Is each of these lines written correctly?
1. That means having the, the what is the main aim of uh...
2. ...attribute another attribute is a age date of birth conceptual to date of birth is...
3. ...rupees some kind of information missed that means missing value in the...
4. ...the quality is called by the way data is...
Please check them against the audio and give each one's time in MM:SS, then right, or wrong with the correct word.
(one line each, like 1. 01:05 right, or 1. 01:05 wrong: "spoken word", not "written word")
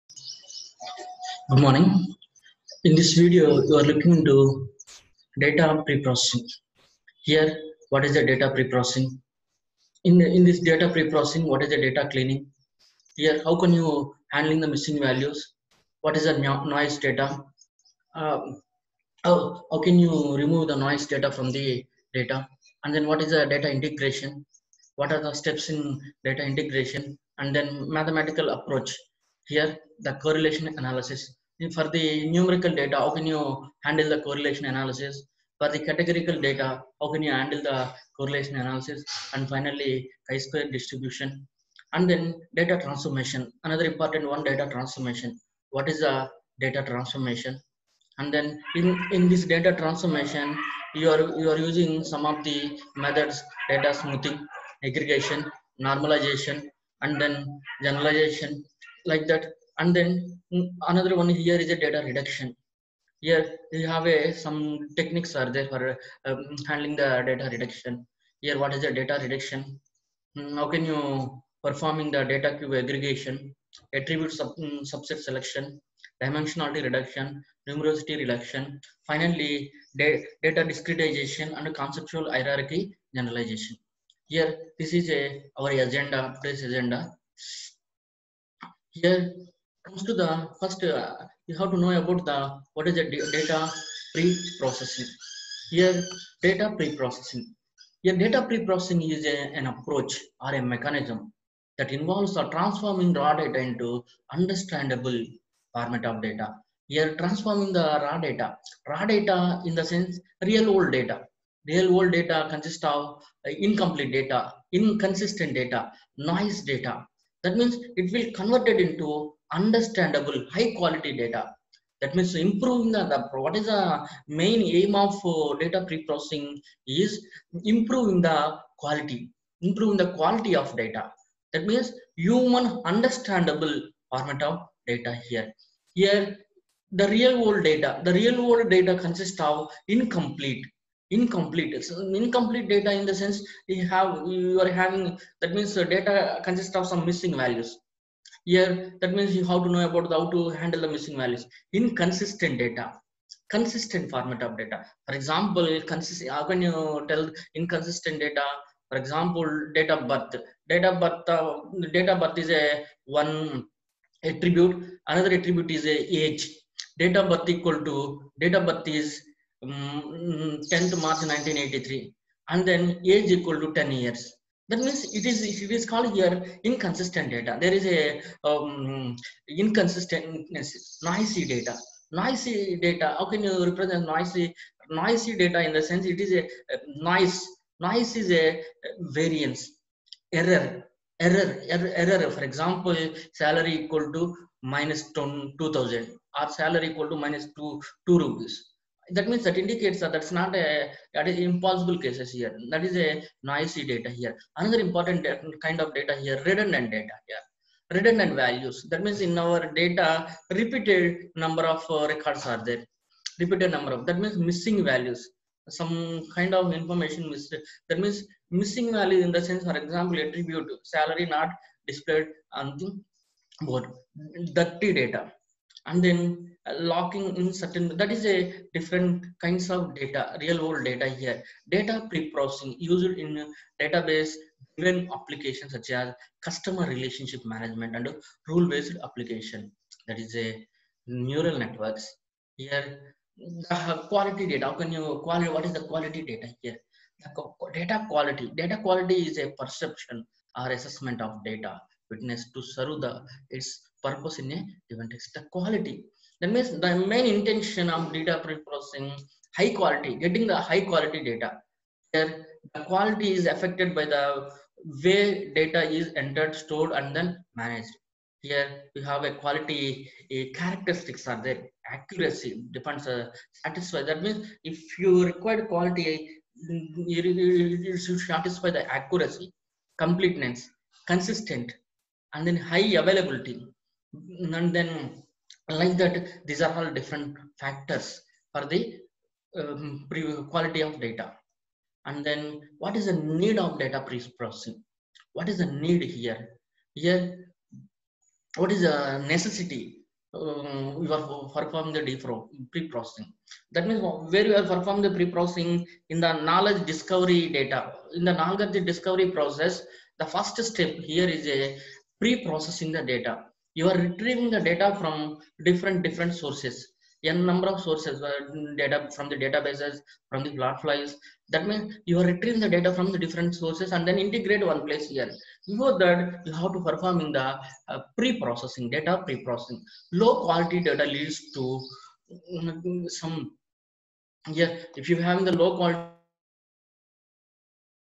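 1. 02:01 wrong: "improving", not "having"
2. 02:44 wrong: "equal", not "conceptual"
3. 03:34 wrong: "values", not "rupees"
4. 04:22 wrong: "affected", not "called".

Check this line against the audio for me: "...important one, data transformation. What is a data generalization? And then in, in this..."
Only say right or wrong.
wrong.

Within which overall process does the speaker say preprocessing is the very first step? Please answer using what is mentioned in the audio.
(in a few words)
knowledge discovery process.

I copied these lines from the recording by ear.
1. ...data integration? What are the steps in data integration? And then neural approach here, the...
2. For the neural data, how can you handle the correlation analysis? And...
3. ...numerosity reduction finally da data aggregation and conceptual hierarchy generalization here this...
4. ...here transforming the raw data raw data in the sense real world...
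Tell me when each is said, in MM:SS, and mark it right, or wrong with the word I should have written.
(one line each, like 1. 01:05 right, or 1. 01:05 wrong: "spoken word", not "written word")
1. 00:23 wrong: "mathematical", not "neural"
2. 00:35 wrong: "categorical", not "neural"
3. 01:17 wrong: "discretization", not "aggregation"
4. 01:46 right.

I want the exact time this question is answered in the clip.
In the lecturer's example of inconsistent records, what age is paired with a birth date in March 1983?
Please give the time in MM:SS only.
02:53.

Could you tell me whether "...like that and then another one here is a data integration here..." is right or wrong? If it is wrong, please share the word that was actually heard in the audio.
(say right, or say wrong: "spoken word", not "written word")
wrong: "reduction", not "integration".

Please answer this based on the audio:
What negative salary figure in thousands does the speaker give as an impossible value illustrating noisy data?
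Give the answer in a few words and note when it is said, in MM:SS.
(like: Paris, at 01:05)
-2000, at 03:14.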